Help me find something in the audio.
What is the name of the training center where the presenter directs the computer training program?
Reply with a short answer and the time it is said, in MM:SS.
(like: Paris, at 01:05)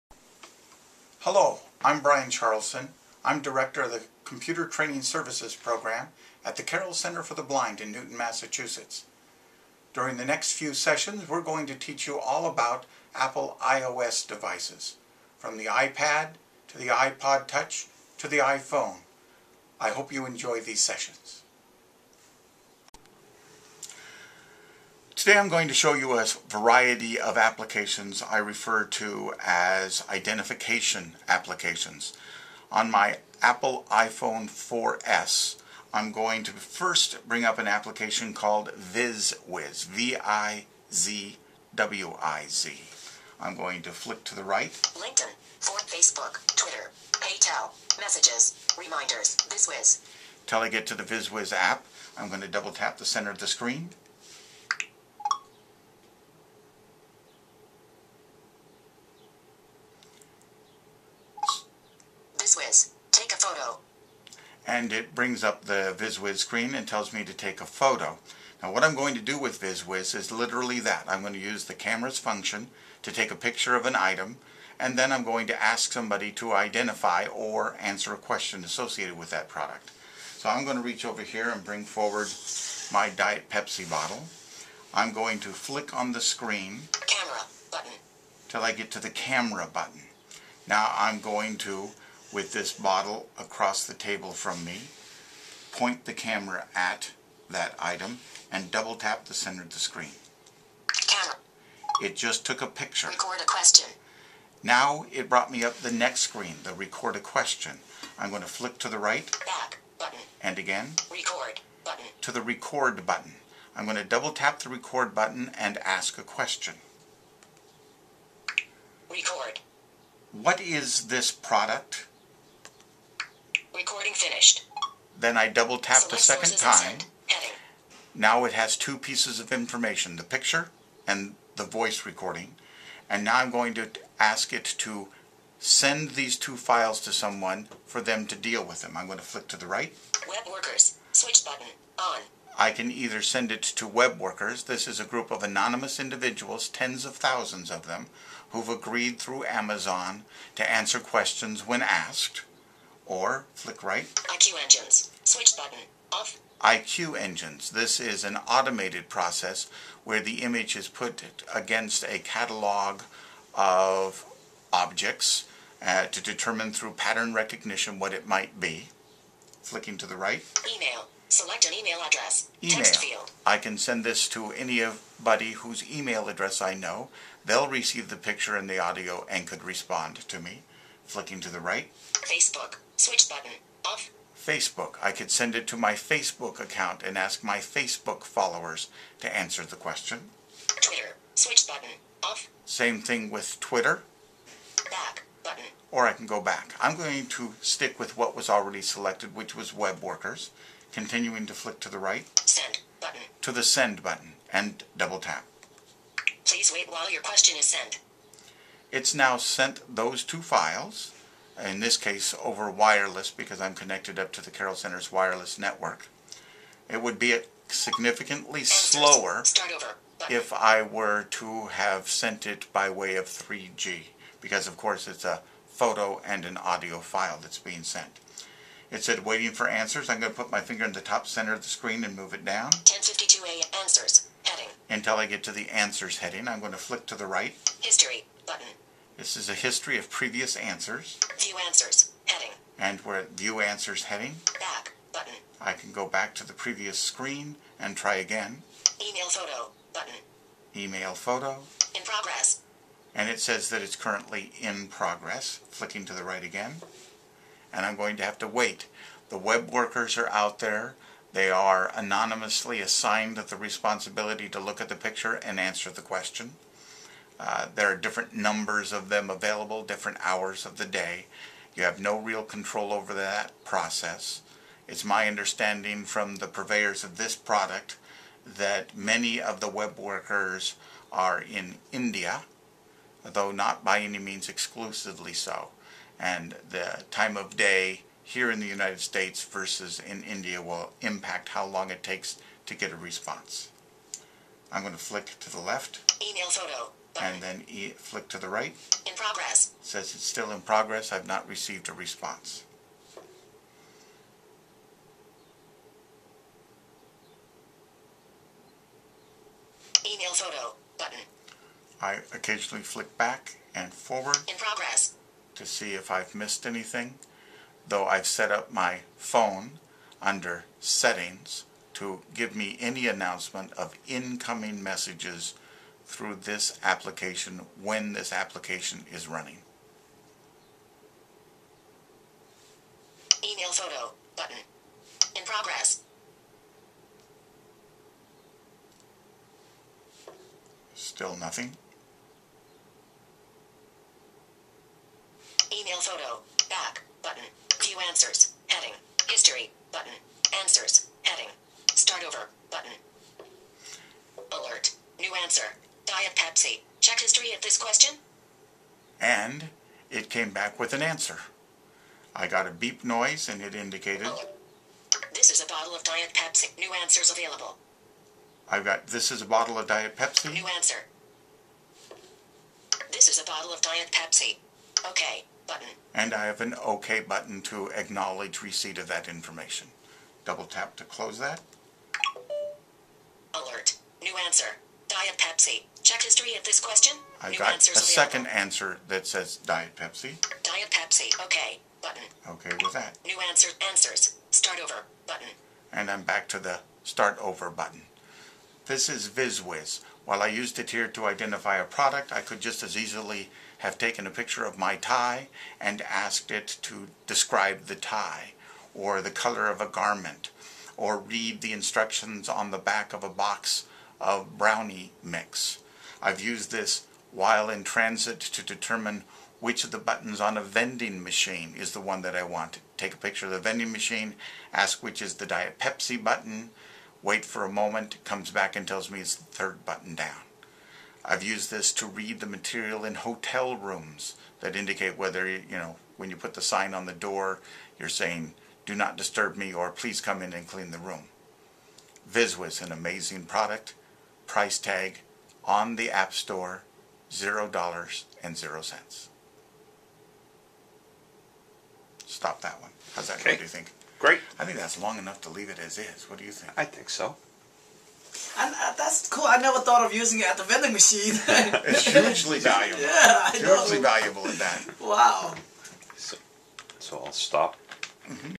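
Carroll Center for the Blind, at 00:06.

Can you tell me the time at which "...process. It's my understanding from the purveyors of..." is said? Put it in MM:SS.
04:33.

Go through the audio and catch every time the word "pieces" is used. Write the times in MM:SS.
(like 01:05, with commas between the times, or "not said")
02:08.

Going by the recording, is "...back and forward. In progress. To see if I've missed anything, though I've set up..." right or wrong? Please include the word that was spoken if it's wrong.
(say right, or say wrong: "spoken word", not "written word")
right.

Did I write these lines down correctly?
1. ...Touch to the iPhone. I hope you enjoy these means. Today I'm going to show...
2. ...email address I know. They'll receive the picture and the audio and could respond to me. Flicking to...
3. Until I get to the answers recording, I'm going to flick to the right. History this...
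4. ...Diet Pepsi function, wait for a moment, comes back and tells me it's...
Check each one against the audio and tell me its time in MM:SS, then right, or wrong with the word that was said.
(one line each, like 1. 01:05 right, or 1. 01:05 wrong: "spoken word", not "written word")
1. 00:17 wrong: "sessions", not "means"
2. 02:55 right
3. 03:54 wrong: "heading", not "recording"
4. 07:05 wrong: "button", not "function".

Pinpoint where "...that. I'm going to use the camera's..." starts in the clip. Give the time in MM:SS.
01:10.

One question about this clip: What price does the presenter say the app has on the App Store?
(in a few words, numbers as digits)
$0.00.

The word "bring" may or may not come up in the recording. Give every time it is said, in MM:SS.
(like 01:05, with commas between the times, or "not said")
00:37, 01:05, 01:21.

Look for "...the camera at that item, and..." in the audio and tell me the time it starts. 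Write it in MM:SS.
01:36.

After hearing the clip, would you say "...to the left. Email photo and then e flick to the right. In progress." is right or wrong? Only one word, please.
right.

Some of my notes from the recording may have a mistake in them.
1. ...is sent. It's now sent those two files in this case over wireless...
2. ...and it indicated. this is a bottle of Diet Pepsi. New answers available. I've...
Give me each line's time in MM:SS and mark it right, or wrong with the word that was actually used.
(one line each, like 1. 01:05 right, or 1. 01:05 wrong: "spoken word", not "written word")
1. 03:27 right
2. 06:03 right.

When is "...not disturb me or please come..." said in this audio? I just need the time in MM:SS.
07:18.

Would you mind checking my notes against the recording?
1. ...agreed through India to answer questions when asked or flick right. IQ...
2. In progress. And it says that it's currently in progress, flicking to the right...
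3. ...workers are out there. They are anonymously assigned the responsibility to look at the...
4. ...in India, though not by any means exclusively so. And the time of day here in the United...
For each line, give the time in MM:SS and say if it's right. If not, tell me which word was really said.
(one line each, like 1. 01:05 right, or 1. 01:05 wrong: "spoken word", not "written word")
1. 02:28 wrong: "Amazon", not "India"
2. 04:11 right
3. 04:19 right
4. 04:41 right.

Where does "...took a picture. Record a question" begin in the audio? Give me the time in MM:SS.
01:42.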